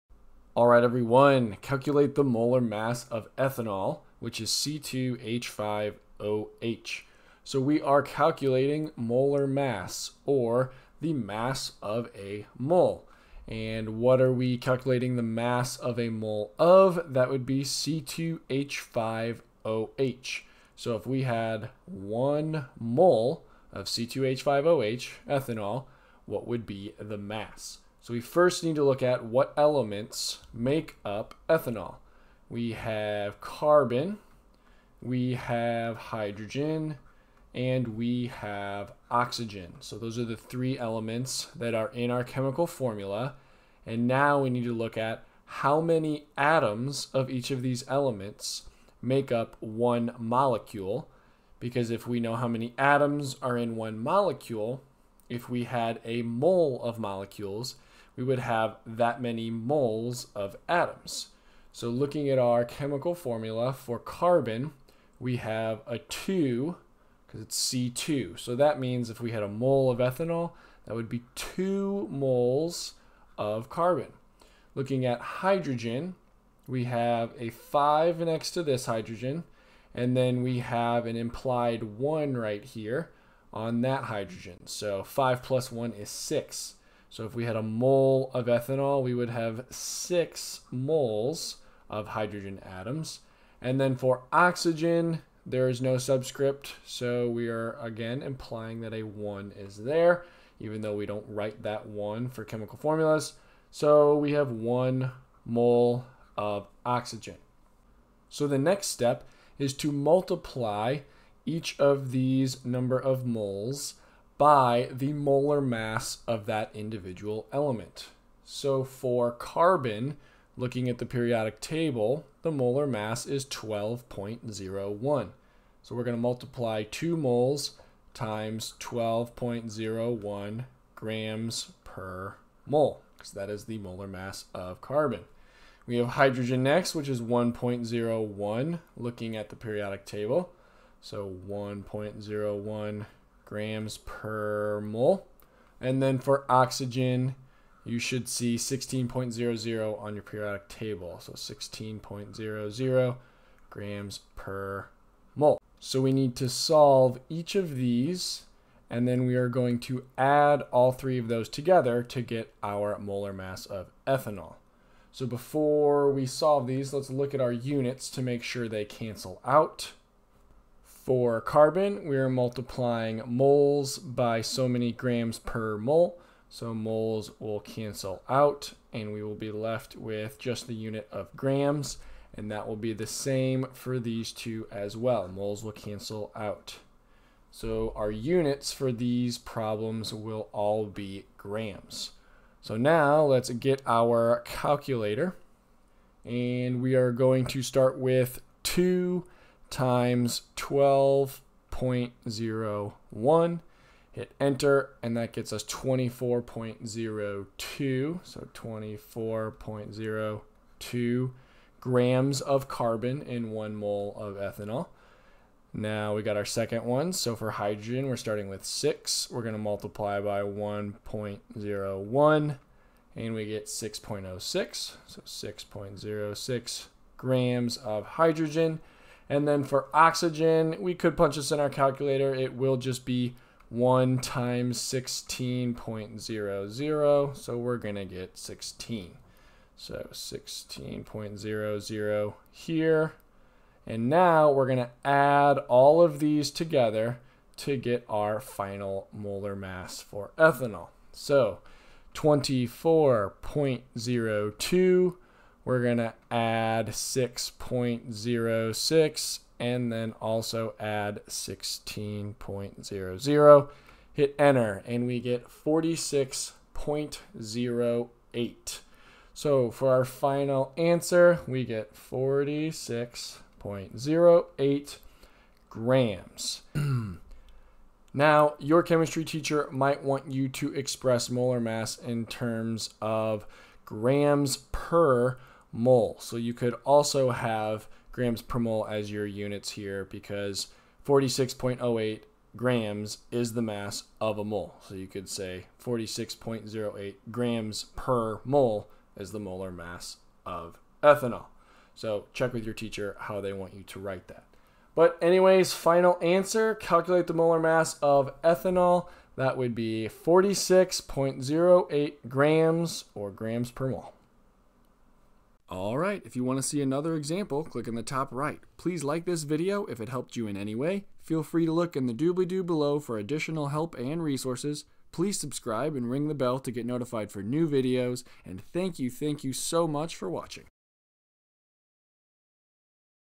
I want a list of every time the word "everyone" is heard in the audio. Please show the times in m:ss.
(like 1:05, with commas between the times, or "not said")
0:00.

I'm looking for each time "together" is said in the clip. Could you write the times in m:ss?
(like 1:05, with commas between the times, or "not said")
2:41, 4:06.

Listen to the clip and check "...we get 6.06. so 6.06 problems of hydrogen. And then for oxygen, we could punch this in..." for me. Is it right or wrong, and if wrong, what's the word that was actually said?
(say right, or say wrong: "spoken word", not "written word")
wrong: "grams", not "problems".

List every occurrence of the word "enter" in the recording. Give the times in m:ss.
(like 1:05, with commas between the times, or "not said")
3:24, 4:24.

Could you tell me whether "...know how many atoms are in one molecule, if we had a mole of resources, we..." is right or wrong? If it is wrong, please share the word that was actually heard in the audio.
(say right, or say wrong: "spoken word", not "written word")
wrong: "molecules", not "resources".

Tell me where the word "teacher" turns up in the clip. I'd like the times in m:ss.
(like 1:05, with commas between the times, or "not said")
4:39, 5:02.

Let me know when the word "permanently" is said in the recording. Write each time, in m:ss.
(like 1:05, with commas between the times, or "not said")
not said.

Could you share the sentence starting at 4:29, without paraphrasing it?
So for our final answer, we get 46.08 grams.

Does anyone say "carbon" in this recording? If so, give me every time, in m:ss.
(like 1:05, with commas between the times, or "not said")
0:33, 1:03, 1:13, 1:59, 2:14, 2:51, 3:32.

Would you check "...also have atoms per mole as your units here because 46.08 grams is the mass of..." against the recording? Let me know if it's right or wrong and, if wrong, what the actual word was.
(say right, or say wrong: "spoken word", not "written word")
wrong: "grams", not "atoms".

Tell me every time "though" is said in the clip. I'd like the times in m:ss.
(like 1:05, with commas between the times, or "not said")
1:40.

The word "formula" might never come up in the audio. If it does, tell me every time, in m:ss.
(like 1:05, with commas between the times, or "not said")
0:42, 1:03, 1:42.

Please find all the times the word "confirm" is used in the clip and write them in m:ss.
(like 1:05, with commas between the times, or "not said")
not said.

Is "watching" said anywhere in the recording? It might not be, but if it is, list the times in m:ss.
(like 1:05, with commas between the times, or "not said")
5:30.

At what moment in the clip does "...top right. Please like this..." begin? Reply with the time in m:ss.
5:18.